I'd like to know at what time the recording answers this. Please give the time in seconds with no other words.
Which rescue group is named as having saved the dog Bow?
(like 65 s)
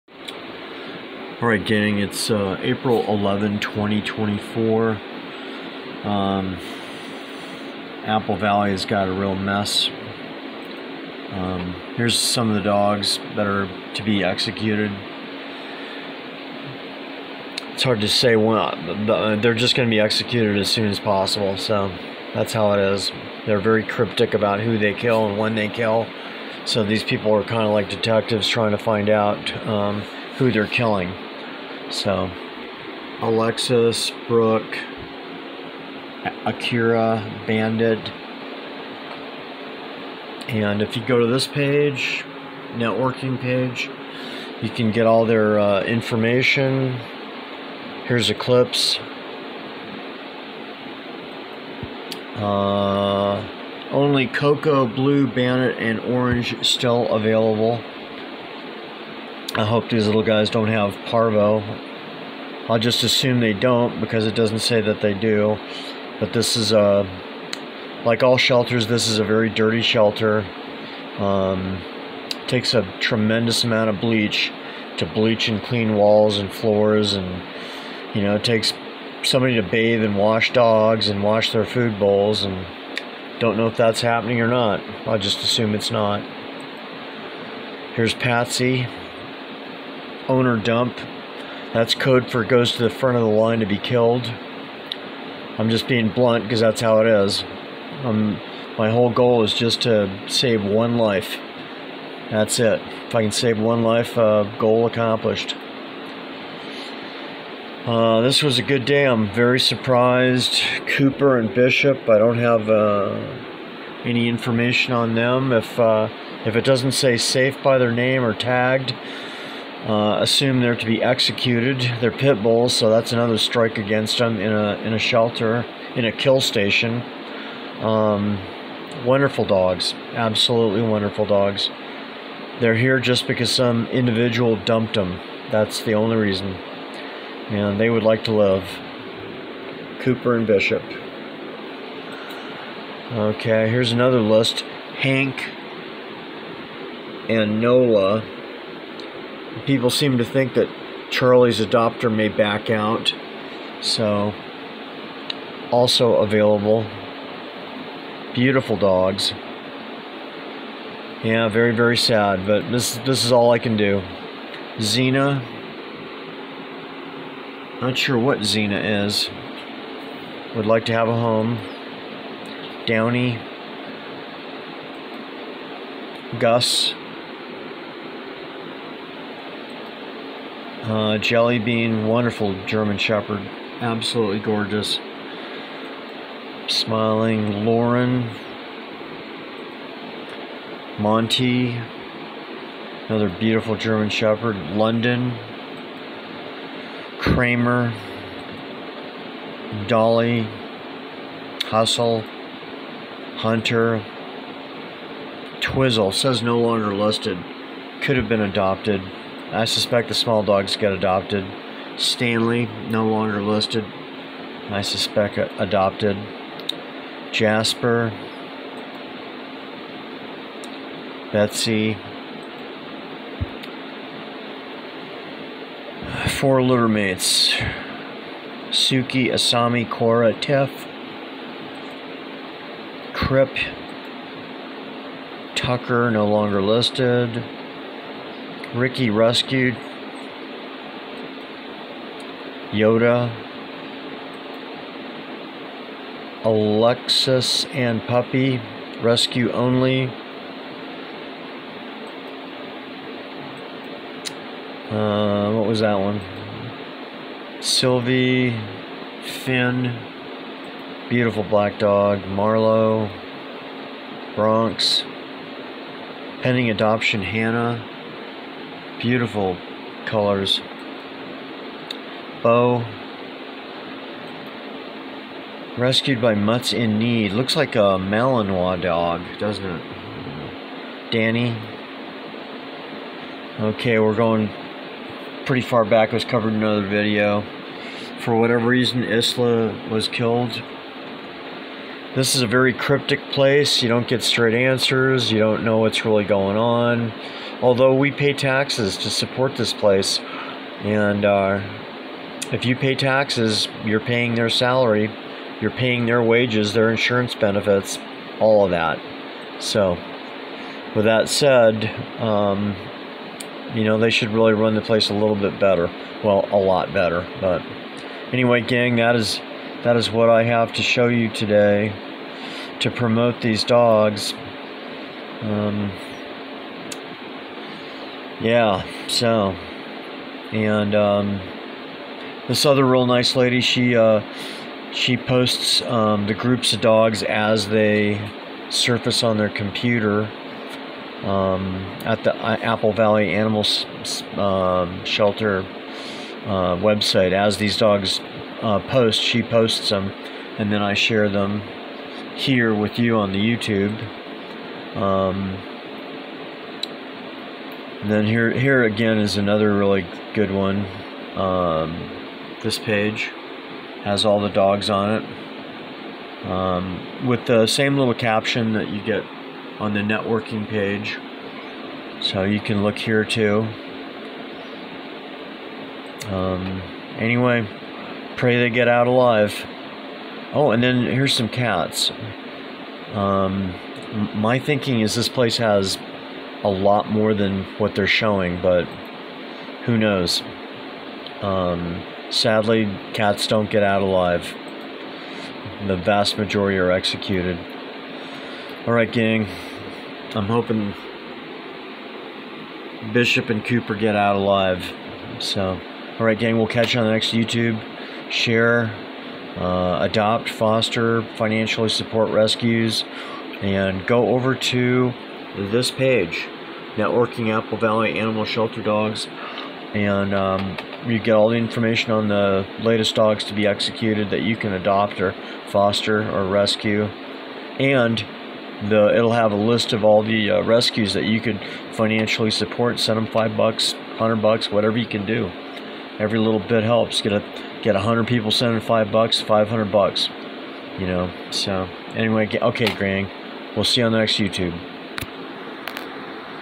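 276 s.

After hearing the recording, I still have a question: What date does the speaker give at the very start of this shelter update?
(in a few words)
April 11, 2024.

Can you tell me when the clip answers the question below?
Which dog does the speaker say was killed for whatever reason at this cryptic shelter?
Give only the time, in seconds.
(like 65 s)
289 s.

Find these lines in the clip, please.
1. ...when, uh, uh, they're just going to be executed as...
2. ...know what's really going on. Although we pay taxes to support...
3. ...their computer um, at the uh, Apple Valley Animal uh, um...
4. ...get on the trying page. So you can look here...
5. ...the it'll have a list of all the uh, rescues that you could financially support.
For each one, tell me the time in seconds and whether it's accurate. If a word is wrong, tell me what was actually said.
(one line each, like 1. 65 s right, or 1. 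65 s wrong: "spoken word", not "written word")
1. 18 s right
2. 295 s right
3. 339 s right
4. 369 s wrong: "networking", not "trying"
5. 428 s right.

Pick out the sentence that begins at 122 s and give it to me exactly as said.
They're pit bulls, so that's another strike against them in a in a shelter in a kill station.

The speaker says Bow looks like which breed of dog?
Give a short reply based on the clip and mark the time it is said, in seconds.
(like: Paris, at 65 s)
Malinois, at 277 s.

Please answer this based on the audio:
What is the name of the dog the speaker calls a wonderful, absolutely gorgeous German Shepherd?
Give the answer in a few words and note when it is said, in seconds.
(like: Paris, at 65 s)
Jelly Bean, at 181 s.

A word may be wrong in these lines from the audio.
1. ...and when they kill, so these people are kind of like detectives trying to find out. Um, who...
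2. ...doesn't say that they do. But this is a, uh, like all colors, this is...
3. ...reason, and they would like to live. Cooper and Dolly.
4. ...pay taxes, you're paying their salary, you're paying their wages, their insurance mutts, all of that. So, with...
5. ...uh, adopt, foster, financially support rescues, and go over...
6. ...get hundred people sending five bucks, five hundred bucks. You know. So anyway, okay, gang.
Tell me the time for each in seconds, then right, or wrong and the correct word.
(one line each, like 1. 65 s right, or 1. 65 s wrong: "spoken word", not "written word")
1. 25 s right
2. 64 s wrong: "shelters", not "colors"
3. 136 s wrong: "Bishop", not "Dolly"
4. 302 s wrong: "benefits", not "mutts"
5. 409 s right
6. 437 s right.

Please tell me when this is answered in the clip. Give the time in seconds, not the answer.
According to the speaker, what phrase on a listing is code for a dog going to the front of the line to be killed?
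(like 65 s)
90 s.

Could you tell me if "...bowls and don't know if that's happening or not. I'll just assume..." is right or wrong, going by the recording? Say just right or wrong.
right.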